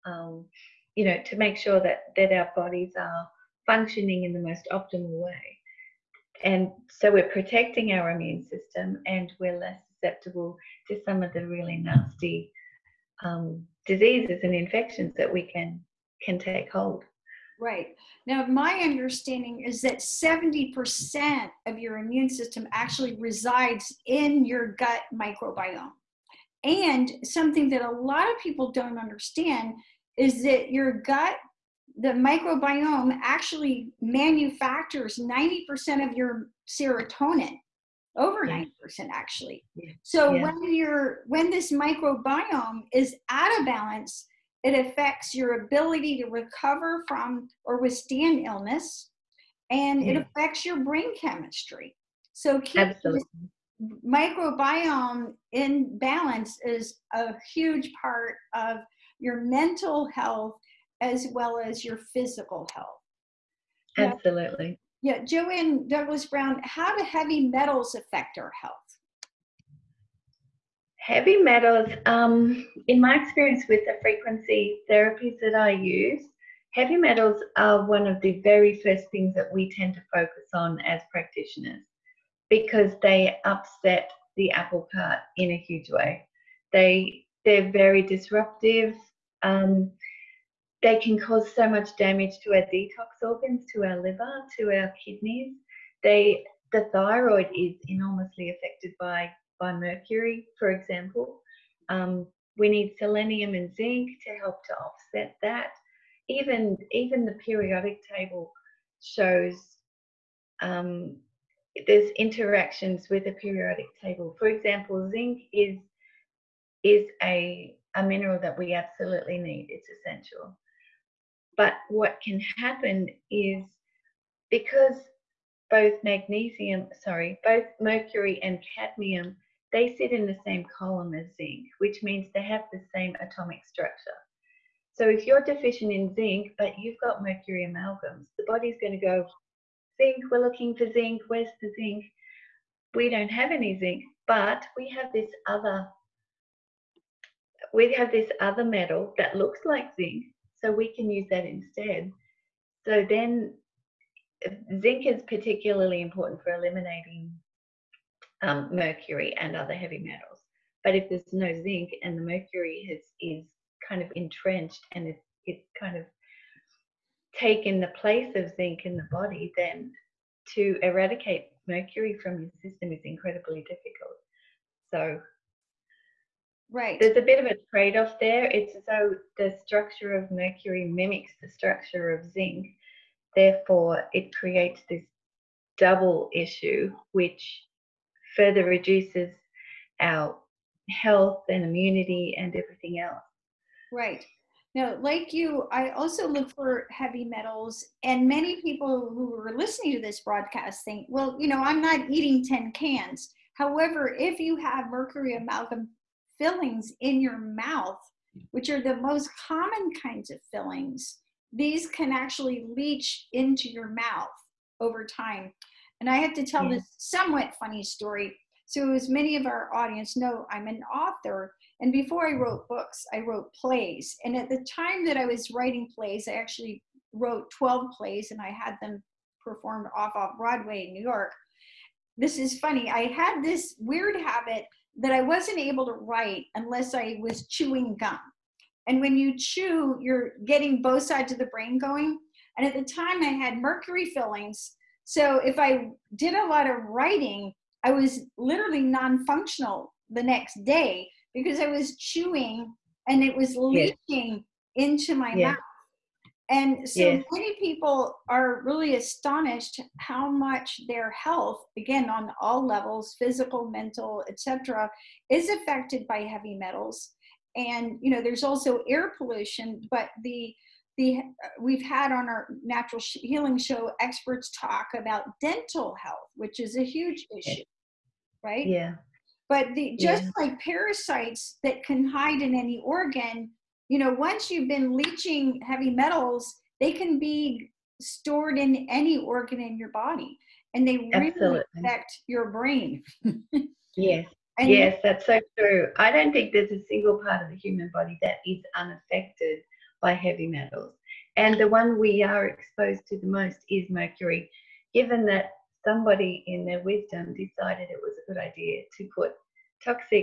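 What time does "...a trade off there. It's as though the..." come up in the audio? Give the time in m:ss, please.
2:57.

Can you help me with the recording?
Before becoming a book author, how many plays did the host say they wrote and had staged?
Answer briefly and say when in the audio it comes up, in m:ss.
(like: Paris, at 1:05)
12, at 3:47.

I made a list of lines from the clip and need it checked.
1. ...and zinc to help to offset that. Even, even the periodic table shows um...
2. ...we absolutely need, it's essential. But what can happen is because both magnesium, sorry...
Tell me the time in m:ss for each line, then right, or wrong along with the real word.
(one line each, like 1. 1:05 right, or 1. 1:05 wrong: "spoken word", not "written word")
1. 1:43 right
2. 1:58 right.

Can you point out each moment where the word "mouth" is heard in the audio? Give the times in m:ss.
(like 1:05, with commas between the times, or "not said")
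3:27, 3:33, 4:15.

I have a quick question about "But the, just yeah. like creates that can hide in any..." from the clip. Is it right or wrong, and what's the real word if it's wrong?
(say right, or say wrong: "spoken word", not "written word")
wrong: "parasites", not "creates".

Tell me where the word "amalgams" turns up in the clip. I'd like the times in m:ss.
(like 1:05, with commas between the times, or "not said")
2:17, 3:25.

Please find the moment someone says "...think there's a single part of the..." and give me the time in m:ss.
4:56.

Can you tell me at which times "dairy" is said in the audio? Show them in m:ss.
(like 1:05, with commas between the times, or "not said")
not said.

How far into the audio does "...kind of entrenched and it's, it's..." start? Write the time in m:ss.
2:43.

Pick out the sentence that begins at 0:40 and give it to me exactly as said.
when you're when this microbiome is out of balance, it affects your ability to recover from or withstand illness, and yeah.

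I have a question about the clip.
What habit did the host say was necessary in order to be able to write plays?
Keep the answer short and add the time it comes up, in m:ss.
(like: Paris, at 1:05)
Chewing gum, at 3:57.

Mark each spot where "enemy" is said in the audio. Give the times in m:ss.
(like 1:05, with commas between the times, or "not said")
not said.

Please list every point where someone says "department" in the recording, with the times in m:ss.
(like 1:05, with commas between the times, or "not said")
not said.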